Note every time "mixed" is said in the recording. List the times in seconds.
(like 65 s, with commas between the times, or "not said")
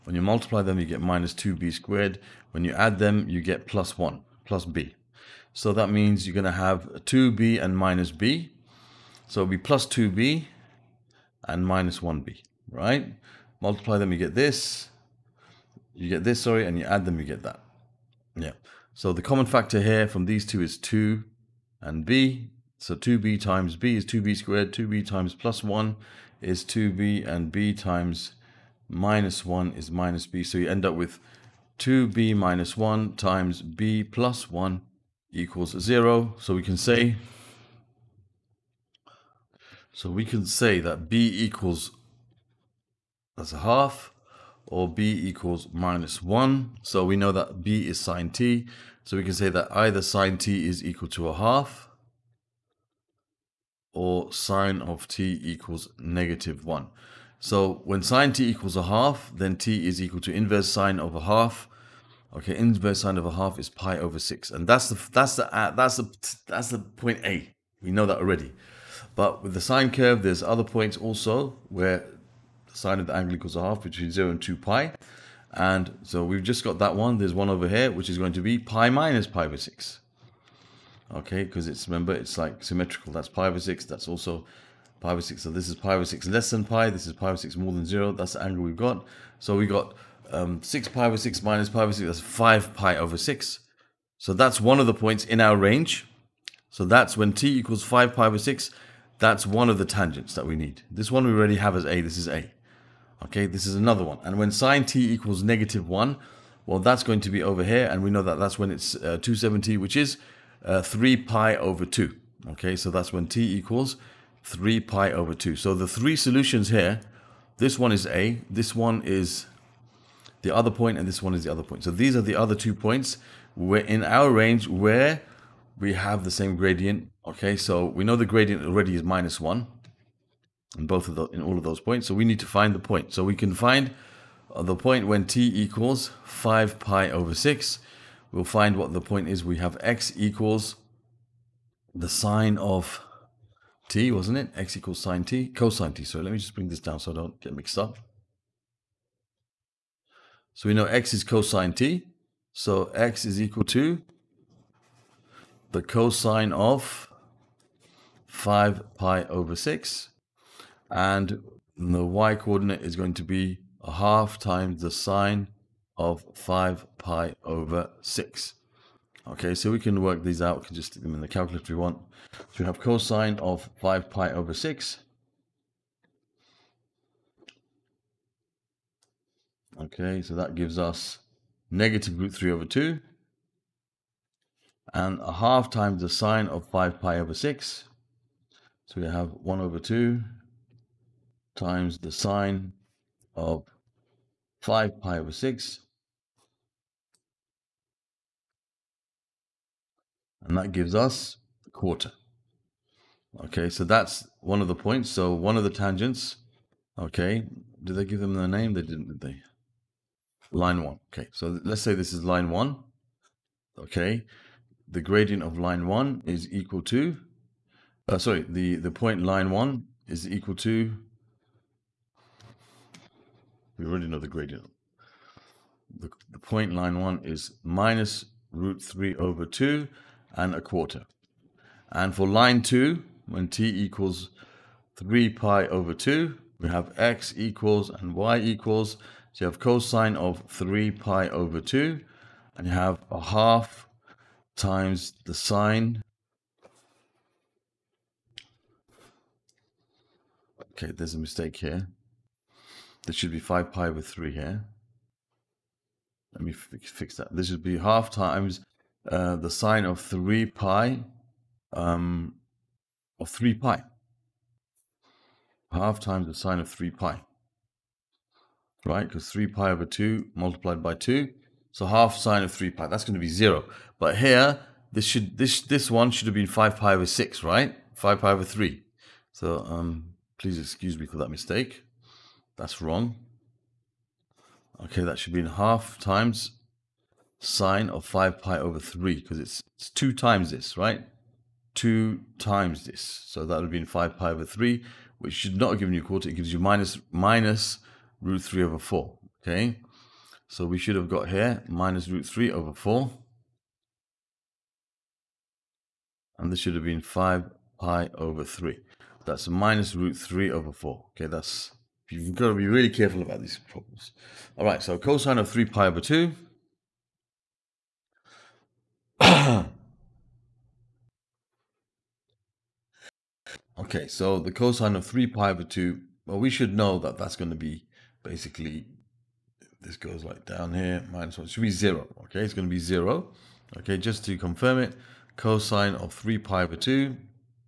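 147 s.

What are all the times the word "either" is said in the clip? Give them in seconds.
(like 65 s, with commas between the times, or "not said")
49 s.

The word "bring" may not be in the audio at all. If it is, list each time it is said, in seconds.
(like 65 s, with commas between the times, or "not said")
146 s.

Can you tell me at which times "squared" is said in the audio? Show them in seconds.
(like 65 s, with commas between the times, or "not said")
1 s, 24 s.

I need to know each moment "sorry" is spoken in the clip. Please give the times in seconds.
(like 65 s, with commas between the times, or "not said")
16 s, 218 s.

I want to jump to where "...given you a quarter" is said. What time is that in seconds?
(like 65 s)
295 s.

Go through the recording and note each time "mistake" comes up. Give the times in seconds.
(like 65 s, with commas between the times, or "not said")
251 s, 281 s.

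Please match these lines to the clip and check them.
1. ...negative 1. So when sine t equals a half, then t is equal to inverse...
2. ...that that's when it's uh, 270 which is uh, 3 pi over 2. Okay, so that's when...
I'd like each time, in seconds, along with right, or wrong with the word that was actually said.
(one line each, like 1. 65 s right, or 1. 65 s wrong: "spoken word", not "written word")
1. 55 s right
2. 108 s right.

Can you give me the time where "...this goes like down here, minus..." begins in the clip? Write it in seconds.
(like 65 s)
329 s.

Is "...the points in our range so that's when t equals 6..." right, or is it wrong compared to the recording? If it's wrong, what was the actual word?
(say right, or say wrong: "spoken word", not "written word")
wrong: "5", not "6".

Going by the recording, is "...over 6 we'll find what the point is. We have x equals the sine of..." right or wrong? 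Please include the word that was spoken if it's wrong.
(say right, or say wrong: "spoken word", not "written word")
right.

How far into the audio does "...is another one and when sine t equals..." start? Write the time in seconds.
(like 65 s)
103 s.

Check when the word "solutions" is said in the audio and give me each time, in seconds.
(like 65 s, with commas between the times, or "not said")
116 s.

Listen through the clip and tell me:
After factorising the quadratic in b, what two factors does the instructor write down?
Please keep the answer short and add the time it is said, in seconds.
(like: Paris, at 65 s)
2b - 1 and b + 1, at 31 s.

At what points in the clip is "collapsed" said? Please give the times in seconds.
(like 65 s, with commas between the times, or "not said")
not said.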